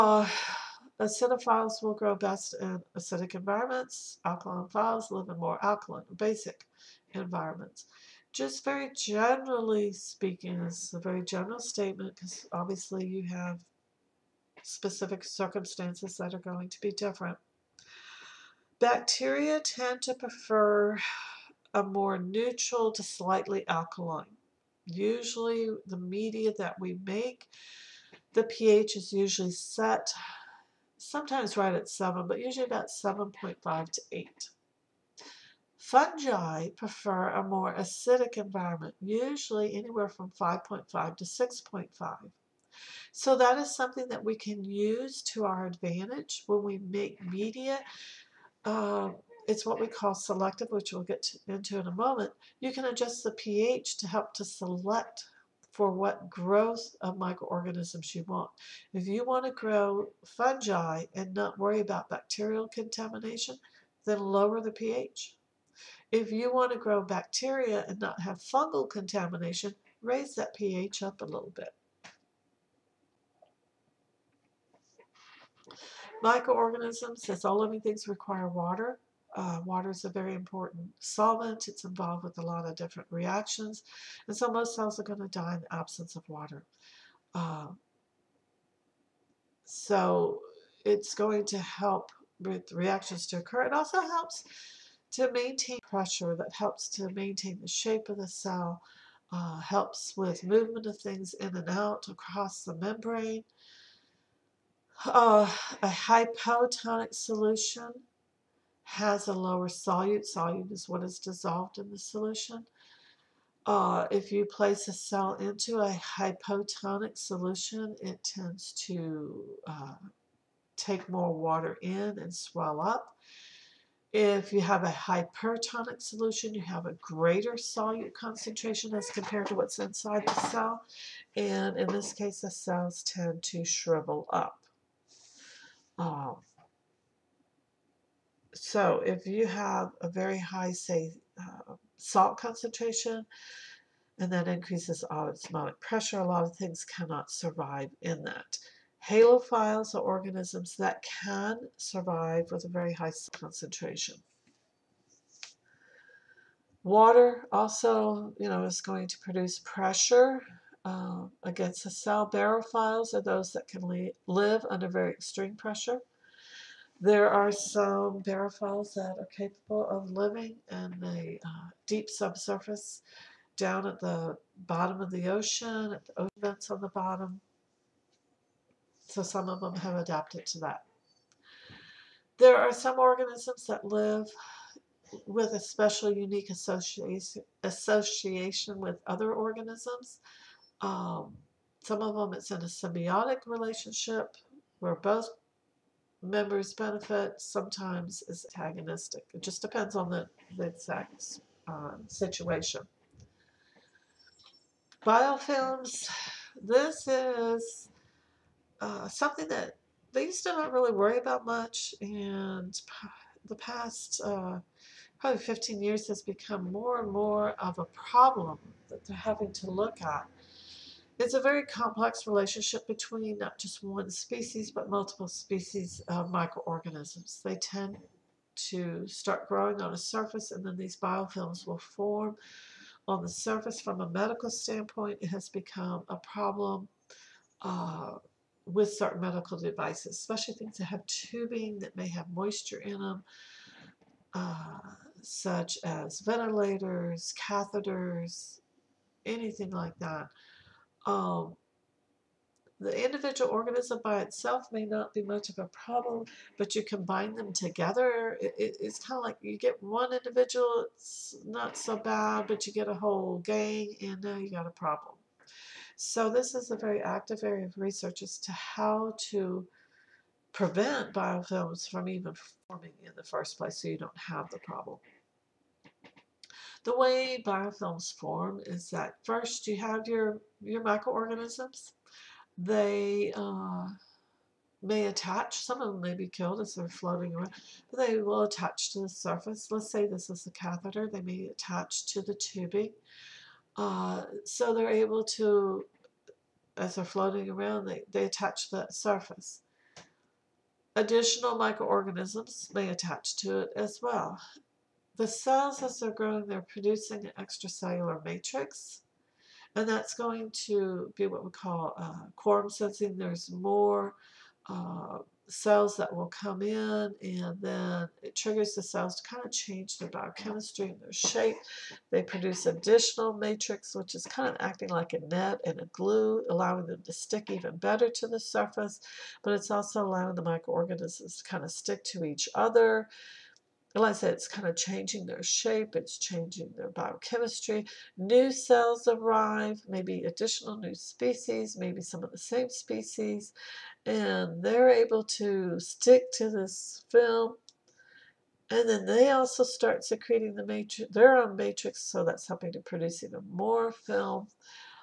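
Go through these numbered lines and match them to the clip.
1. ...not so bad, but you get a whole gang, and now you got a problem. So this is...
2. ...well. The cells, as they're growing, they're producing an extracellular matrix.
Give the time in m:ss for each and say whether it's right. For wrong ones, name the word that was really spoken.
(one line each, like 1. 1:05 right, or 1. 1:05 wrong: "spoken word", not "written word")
1. 4:21 right
2. 5:04 right.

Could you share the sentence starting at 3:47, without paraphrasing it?
They tend to start growing on a surface and then these biofilms will form on the surface.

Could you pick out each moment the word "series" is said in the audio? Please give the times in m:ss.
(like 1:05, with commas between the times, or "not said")
not said.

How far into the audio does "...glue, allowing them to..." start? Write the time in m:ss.
5:25.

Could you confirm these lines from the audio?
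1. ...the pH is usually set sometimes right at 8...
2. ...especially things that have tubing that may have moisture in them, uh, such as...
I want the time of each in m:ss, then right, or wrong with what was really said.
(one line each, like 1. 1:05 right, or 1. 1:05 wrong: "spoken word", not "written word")
1. 0:28 wrong: "7", not "8"
2. 4:00 right.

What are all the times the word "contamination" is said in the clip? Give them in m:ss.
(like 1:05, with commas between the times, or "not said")
1:02, 1:08.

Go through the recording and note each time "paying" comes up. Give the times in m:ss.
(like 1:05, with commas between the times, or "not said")
not said.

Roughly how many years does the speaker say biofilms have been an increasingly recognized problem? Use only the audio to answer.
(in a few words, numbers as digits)
15 years.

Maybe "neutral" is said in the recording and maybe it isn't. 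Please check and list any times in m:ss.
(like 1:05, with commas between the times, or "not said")
0:22.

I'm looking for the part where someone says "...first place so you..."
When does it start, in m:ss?
4:33.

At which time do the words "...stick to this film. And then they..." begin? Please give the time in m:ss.
5:45.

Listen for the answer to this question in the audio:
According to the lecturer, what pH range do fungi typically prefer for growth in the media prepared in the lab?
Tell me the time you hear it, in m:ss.
0:40.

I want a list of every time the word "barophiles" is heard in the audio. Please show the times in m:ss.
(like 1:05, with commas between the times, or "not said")
2:42, 2:48.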